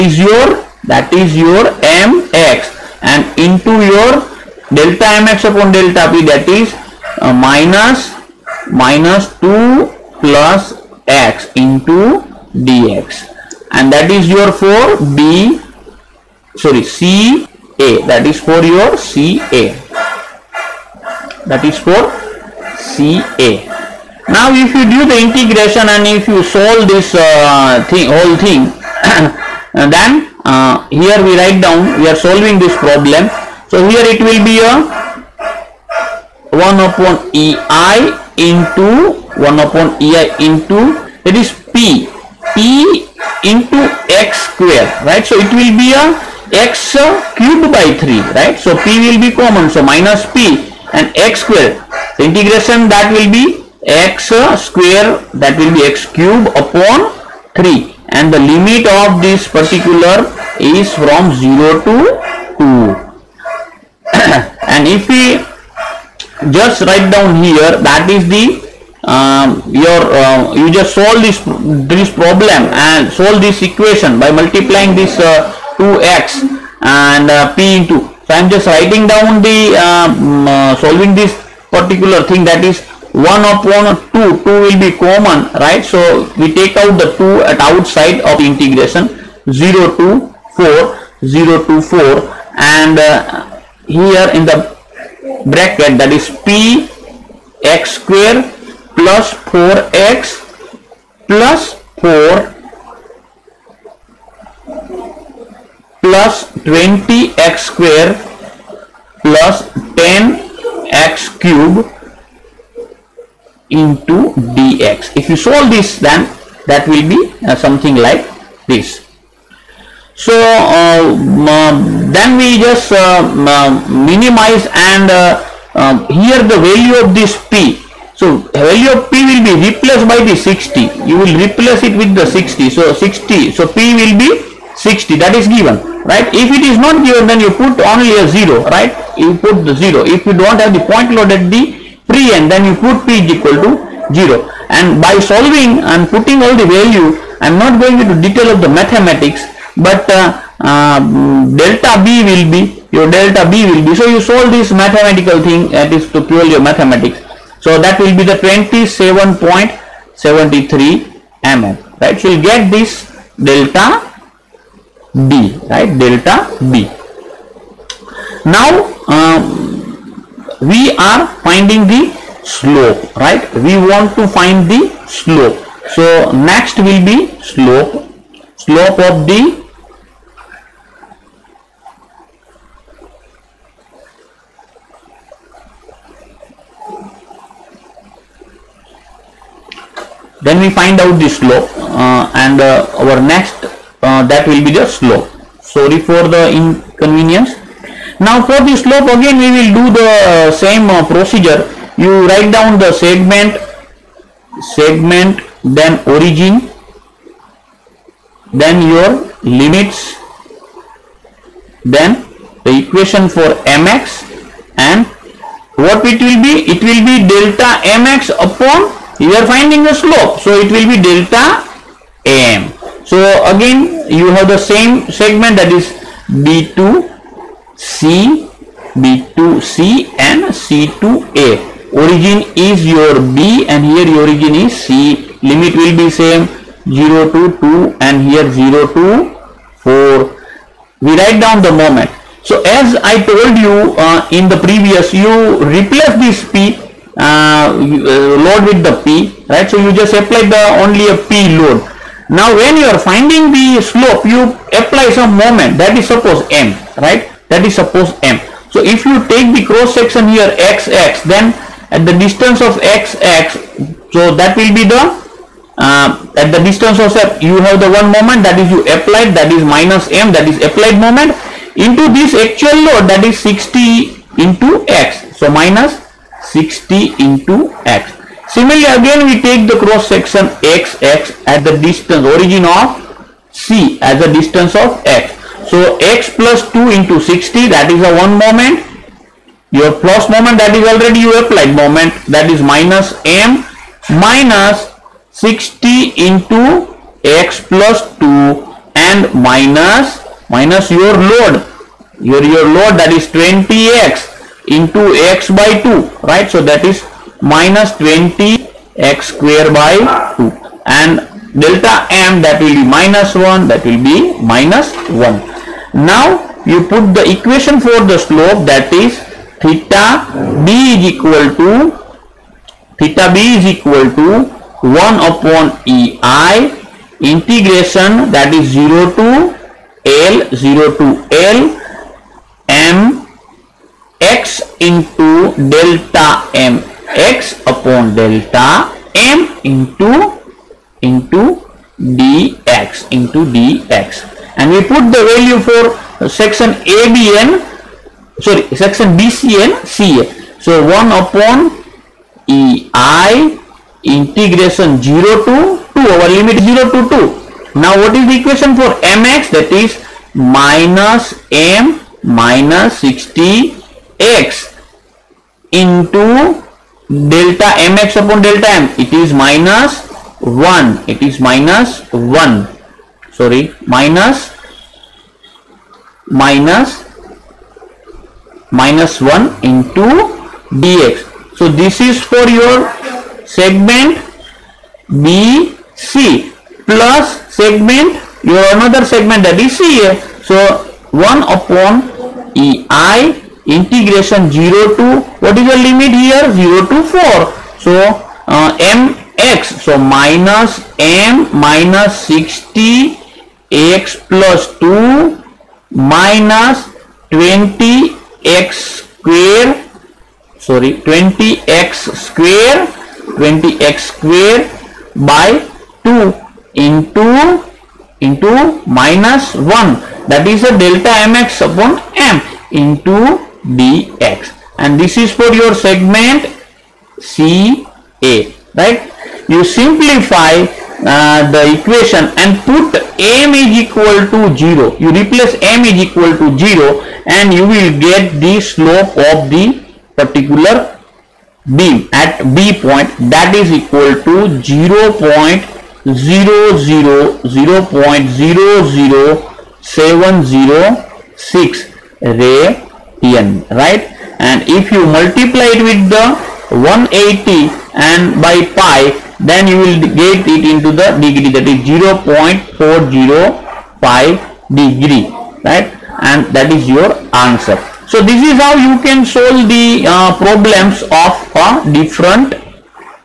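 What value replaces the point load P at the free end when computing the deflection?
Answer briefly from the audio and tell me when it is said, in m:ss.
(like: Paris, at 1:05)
60, at 2:13.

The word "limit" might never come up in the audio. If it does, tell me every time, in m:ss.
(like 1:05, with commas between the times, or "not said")
0:58, 3:29, 3:55, 5:56, 6:35.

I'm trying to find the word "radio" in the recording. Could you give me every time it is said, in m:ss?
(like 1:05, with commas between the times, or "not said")
not said.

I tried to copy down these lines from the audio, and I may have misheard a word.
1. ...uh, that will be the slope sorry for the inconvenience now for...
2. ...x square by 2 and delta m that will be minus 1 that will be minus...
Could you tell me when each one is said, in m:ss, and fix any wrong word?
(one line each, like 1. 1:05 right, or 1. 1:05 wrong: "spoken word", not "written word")
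1. 3:14 right
2. 5:08 right.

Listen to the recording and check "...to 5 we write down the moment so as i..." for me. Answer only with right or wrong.
wrong.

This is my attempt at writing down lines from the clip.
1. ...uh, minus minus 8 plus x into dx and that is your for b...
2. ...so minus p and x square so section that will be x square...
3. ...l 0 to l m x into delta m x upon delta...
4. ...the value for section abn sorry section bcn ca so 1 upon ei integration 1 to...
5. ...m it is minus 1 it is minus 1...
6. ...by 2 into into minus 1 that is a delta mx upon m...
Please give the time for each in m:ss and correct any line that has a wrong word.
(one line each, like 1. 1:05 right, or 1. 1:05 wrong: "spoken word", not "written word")
1. 0:07 wrong: "2", not "8"
2. 0:49 wrong: "integration", not "section"
3. 5:30 right
4. 5:45 wrong: "0", not "1"
5. 6:08 right
6. 6:55 right.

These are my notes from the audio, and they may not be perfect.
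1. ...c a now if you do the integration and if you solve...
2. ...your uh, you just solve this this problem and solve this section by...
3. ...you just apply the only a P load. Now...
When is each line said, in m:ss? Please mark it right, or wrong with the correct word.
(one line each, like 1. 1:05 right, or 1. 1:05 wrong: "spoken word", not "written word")
1. 0:22 right
2. 1:09 wrong: "equation", not "section"
3. 4:09 right.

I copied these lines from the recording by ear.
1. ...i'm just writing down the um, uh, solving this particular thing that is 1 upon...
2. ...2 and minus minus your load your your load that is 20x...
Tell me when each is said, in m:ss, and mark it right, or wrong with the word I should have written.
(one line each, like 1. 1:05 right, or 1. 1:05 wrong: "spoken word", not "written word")
1. 1:18 right
2. 4:58 right.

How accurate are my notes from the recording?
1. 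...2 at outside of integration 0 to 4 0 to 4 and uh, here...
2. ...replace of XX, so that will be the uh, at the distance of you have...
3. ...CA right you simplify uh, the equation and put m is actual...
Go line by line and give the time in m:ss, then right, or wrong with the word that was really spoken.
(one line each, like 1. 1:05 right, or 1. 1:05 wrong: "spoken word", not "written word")
1. 1:27 right
2. 4:22 wrong: "distance", not "replace"
3. 7:07 wrong: "equal", not "actual".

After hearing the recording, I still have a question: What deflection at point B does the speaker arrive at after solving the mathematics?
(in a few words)
27.73 mm.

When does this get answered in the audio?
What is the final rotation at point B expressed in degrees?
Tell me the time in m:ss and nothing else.
7:41.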